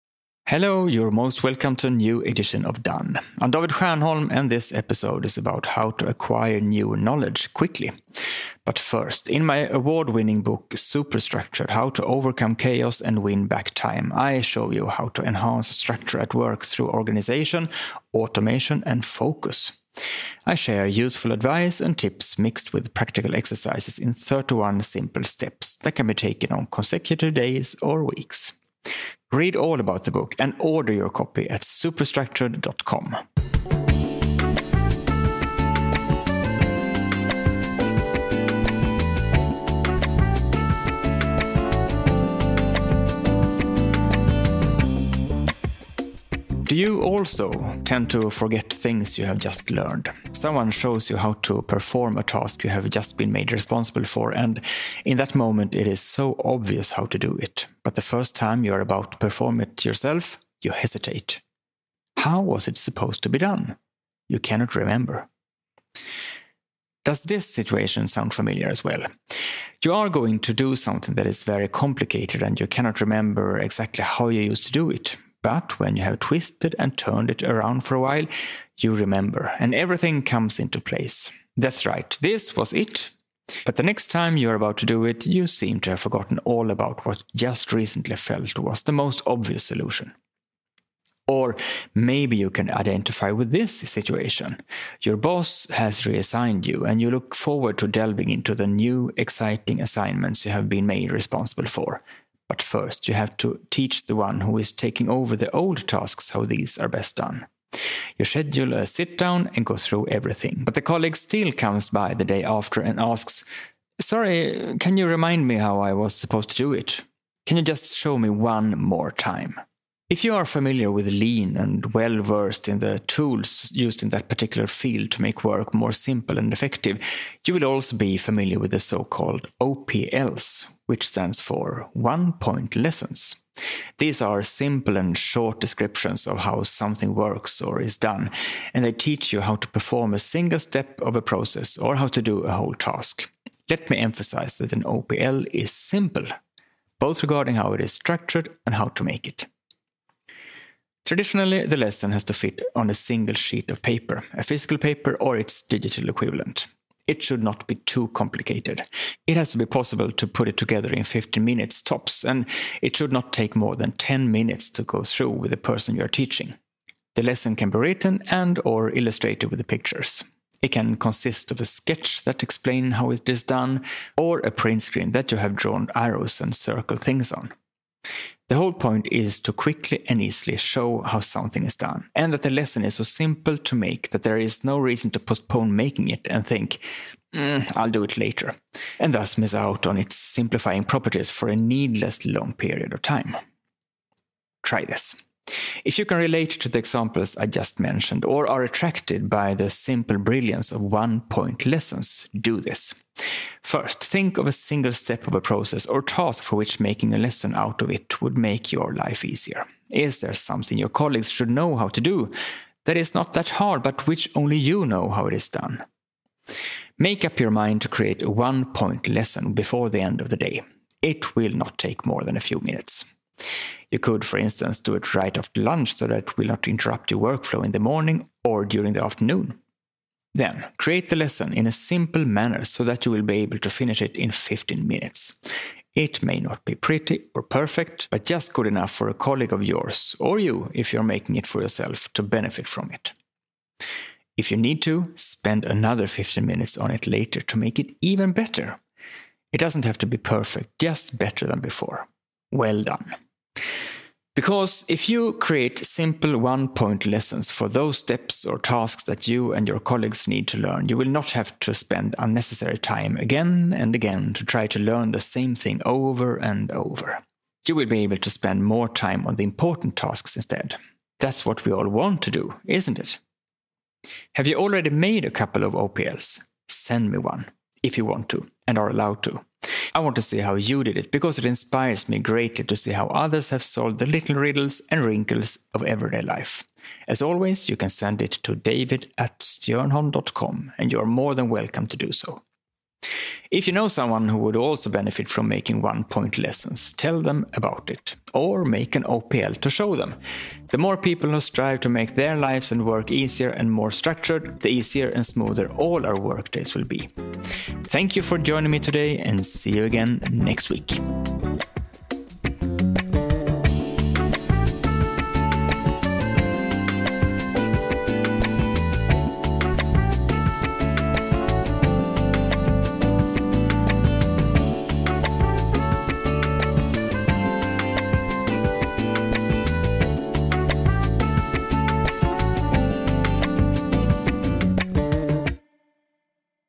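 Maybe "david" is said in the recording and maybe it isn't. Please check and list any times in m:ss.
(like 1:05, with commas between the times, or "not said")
0:03, 4:48.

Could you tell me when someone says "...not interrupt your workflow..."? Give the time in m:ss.
3:46.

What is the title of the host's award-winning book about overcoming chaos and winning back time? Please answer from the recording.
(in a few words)
Superstructured.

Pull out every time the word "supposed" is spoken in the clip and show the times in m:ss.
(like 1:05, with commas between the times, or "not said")
1:02, 1:56.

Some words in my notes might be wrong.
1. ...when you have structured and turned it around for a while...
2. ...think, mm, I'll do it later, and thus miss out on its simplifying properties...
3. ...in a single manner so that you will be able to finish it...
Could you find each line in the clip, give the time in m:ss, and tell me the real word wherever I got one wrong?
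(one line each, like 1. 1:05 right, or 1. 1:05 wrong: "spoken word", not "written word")
1. 1:15 wrong: "twisted", not "structured"
2. 3:06 right
3. 3:51 wrong: "simple", not "single".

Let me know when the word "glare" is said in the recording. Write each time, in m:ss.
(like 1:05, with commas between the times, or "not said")
not said.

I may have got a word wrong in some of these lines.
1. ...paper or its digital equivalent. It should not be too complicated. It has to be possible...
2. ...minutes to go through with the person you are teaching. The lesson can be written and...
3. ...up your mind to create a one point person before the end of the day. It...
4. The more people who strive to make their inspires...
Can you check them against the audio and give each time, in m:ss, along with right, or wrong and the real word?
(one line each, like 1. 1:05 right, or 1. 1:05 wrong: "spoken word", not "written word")
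1. 2:34 right
2. 2:44 right
3. 3:37 wrong: "lesson", not "person"
4. 5:00 wrong: "lives", not "inspires".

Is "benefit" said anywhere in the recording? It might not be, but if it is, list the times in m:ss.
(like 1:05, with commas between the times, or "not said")
4:02, 4:54.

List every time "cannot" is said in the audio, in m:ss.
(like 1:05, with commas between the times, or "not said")
1:04, 1:12.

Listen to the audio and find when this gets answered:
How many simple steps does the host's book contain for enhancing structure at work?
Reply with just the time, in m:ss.
0:24.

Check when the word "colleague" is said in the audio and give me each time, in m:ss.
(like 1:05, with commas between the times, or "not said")
1:50, 3:30, 3:59, 4:19.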